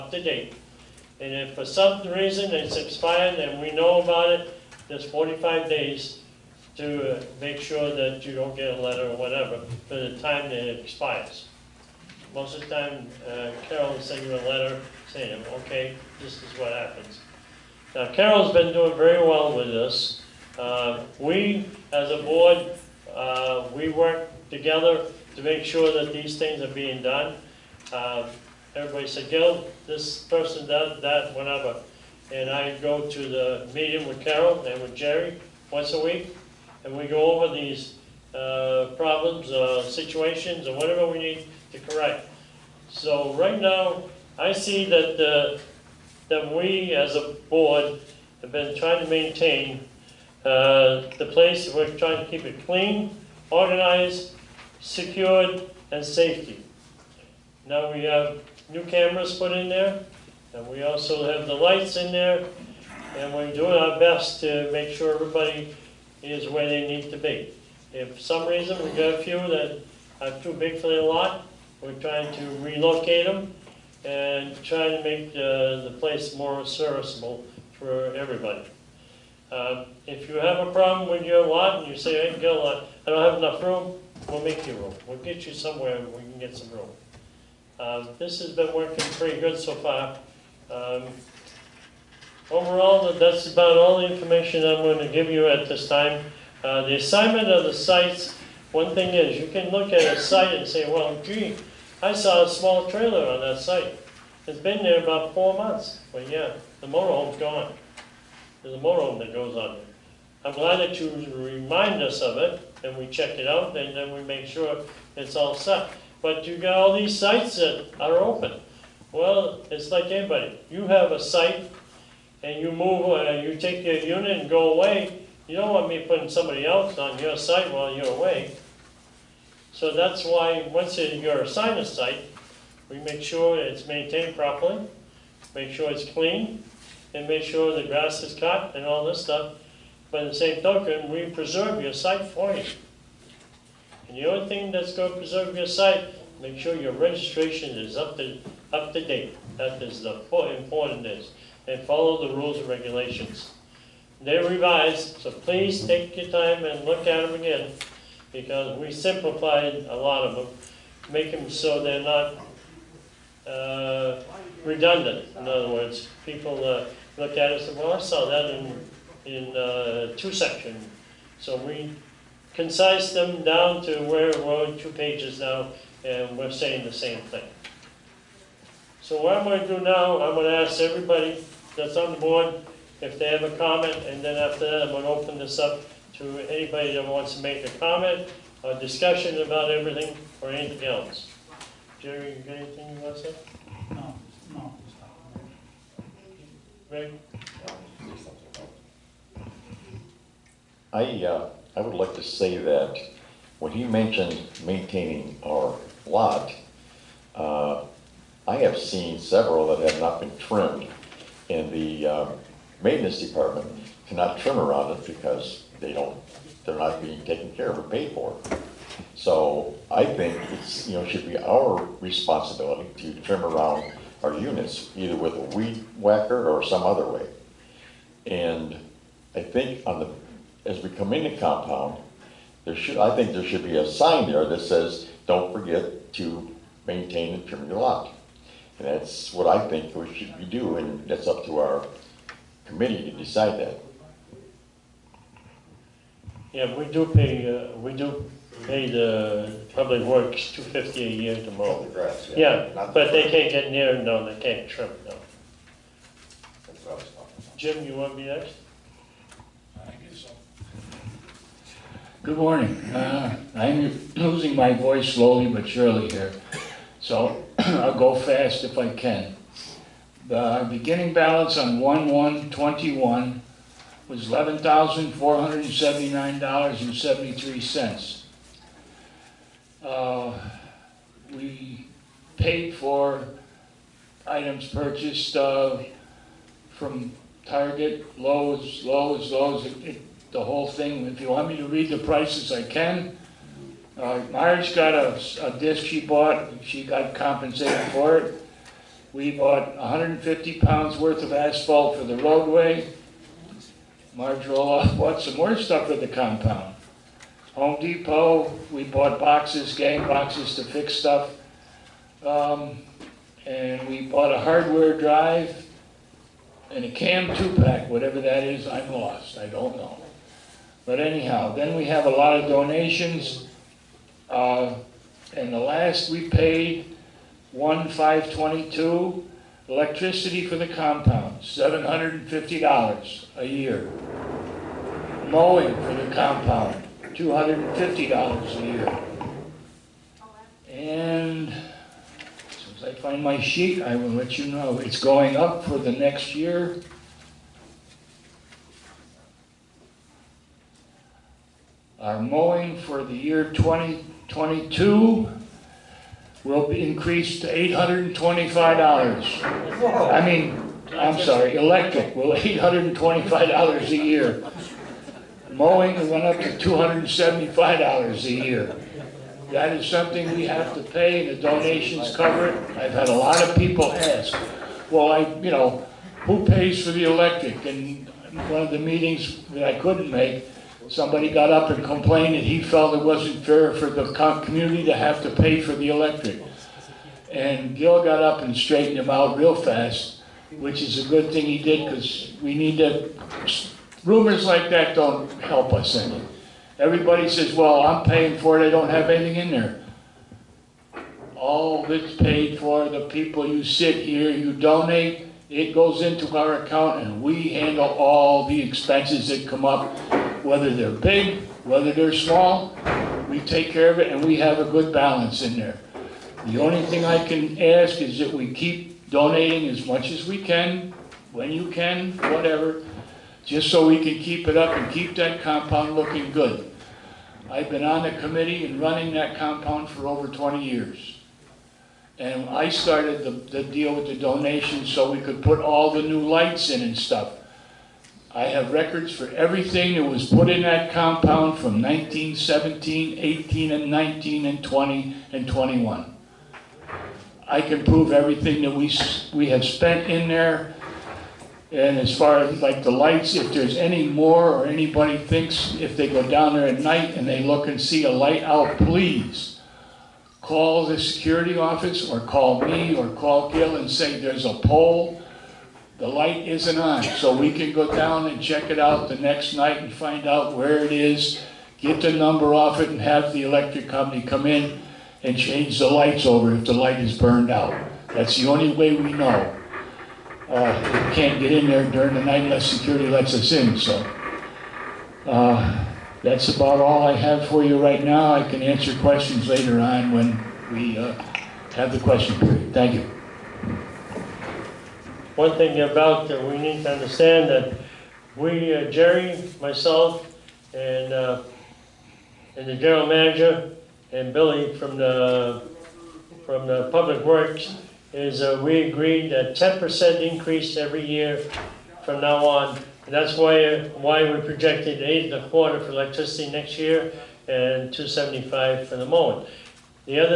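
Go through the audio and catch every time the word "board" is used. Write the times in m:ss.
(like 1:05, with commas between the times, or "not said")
0:22, 0:47, 3:02.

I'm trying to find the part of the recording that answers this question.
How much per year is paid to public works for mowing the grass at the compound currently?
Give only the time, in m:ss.
5:37.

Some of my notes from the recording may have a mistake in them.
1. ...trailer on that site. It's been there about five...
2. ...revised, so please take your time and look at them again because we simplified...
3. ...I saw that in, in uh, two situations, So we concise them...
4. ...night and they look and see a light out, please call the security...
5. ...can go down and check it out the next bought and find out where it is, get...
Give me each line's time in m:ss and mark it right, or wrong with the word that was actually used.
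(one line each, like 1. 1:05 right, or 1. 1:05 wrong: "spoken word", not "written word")
1. 1:42 wrong: "four", not "five"
2. 2:34 right
3. 2:47 wrong: "sections", not "situations"
4. 7:36 right
5. 7:47 wrong: "night", not "bought".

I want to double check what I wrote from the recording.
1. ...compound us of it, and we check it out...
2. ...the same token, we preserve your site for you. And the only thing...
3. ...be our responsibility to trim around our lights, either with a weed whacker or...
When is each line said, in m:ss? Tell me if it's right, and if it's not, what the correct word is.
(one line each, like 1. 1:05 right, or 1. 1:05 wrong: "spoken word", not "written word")
1. 1:51 wrong: "remind", not "compound"
2. 2:20 right
3. 3:41 wrong: "units", not "lights".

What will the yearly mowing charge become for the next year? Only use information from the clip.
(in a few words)
$275.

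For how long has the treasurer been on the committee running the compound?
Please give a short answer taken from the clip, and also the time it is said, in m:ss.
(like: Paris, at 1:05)
over 20 years, at 7:10.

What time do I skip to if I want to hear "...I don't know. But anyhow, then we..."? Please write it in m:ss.
5:19.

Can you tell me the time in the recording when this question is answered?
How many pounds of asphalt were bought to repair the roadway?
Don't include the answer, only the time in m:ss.
4:59.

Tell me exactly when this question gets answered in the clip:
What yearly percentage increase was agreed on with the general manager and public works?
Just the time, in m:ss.
8:29.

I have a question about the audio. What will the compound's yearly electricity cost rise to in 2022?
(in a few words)
$825.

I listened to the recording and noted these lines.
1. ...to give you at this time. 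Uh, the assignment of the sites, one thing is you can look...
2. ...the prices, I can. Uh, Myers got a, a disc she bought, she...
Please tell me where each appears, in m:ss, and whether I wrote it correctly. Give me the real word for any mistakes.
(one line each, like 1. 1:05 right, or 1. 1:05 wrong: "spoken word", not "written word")
1. 1:34 right
2. 4:51 right.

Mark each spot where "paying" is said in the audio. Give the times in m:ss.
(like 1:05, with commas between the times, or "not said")
6:38.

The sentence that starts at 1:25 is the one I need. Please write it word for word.
We'll get you somewhere where we can get some room.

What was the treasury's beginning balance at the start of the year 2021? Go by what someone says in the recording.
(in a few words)
$11,479.73.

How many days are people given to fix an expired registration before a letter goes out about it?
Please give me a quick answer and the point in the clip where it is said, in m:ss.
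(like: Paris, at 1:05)
45, at 0:05.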